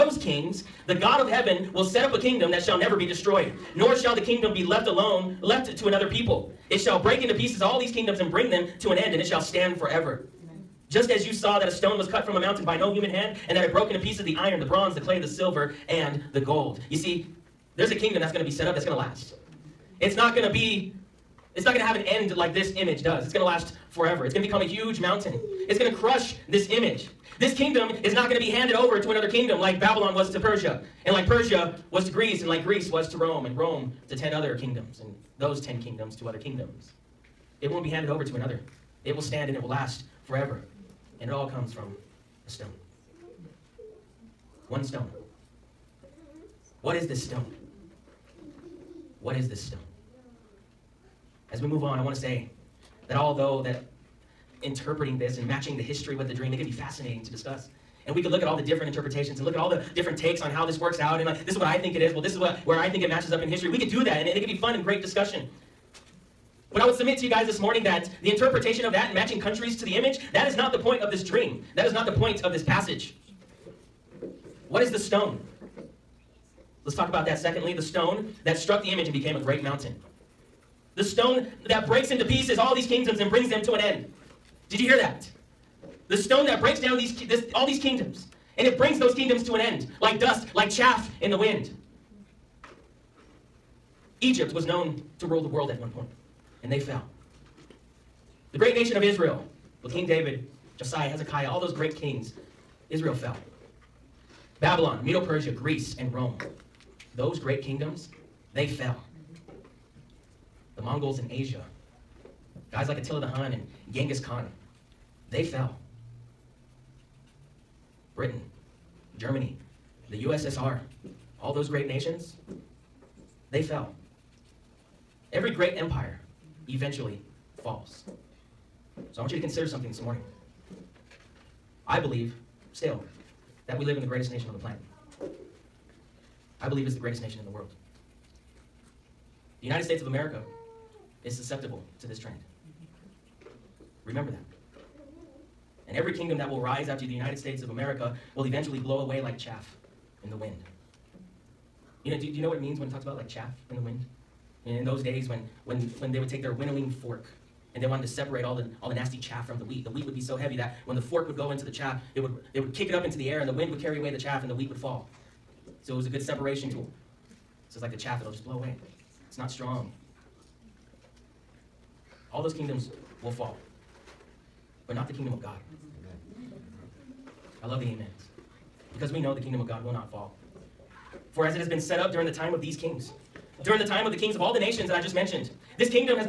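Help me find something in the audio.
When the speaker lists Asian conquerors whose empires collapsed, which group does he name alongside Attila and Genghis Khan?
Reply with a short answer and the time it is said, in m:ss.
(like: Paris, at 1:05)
The Mongols, at 1:50.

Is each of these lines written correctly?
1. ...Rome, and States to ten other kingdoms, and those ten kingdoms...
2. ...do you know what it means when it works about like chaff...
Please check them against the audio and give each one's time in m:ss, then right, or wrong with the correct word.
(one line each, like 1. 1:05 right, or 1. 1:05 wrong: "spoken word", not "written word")
1. 0:33 wrong: "Rome", not "States"
2. 2:32 wrong: "talks", not "works".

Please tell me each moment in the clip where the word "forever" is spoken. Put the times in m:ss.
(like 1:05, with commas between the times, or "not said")
0:09, 0:23, 0:40.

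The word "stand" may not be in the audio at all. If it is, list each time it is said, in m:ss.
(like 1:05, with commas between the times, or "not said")
0:09, 0:39.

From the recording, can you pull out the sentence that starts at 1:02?
Well, this is what where I think it matches up in history.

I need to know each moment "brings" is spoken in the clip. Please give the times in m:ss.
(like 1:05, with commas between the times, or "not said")
0:08, 1:23, 1:28.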